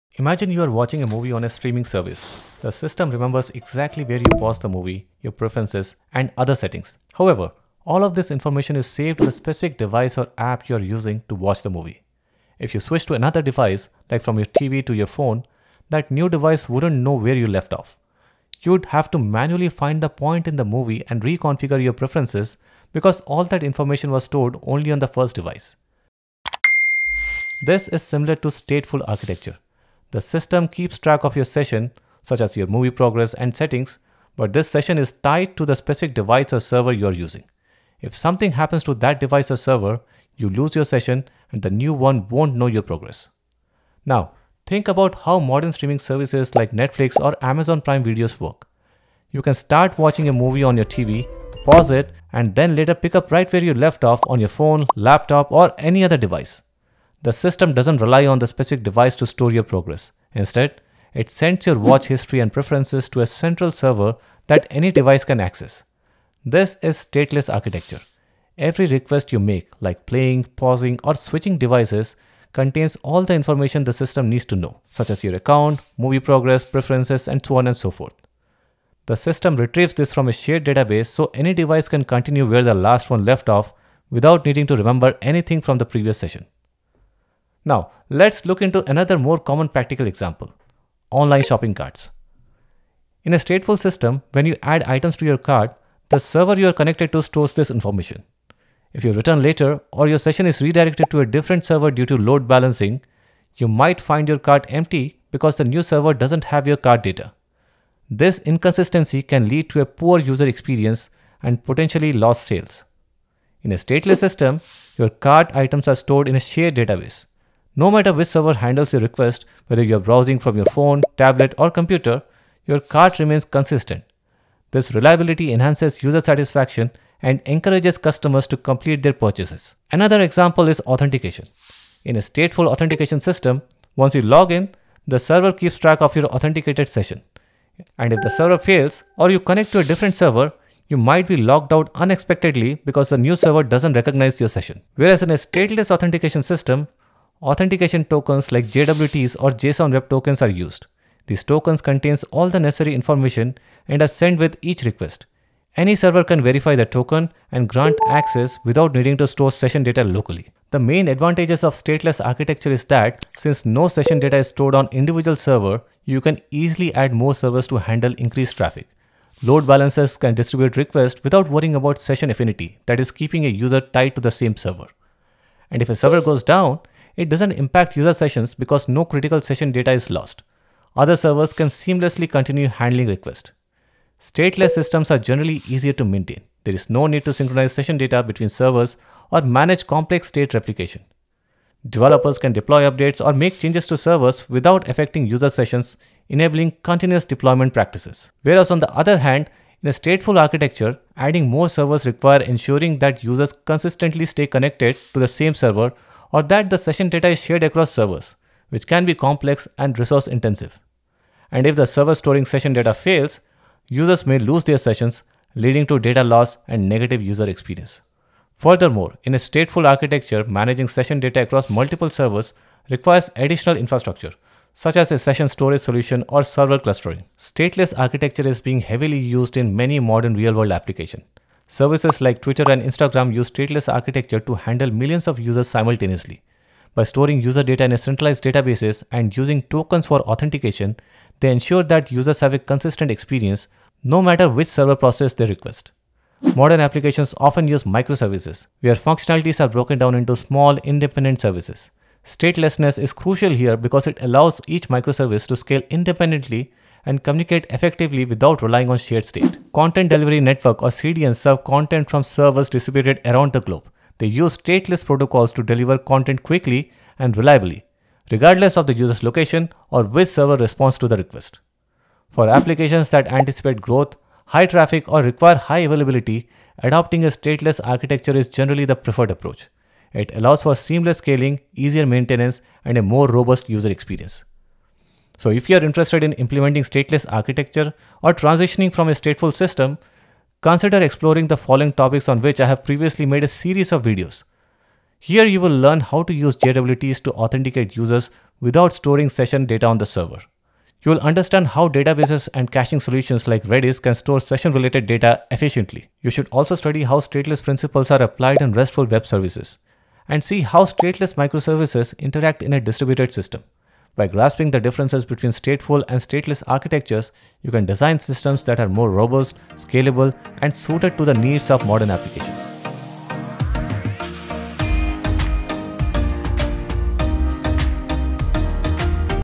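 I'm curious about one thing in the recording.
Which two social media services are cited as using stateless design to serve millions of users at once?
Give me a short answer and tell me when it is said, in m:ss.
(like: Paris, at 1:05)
Twitter and Instagram, at 3:52.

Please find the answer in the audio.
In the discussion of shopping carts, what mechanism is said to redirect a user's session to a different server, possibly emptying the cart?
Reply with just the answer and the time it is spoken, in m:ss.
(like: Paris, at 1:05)
load balancing, at 1:42.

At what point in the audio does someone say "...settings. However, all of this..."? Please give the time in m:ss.
0:06.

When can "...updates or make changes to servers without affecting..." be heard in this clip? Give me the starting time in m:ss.
3:12.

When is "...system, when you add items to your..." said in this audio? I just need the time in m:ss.
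1:33.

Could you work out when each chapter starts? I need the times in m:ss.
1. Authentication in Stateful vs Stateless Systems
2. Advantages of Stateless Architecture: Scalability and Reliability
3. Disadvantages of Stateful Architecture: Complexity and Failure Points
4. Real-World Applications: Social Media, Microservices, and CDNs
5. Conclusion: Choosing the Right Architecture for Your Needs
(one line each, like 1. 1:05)
1. 2:11
2. 2:44
3. 3:21
4. 3:48
5. 4:50.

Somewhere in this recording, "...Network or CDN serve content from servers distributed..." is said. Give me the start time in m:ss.
4:20.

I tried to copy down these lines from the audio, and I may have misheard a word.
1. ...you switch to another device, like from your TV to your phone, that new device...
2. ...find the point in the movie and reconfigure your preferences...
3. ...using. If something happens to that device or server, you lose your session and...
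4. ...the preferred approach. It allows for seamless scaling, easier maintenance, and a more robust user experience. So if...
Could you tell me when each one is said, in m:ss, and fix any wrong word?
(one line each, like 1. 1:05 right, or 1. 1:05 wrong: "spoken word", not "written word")
1. 0:12 right
2. 0:19 right
3. 0:37 right
4. 4:38 right.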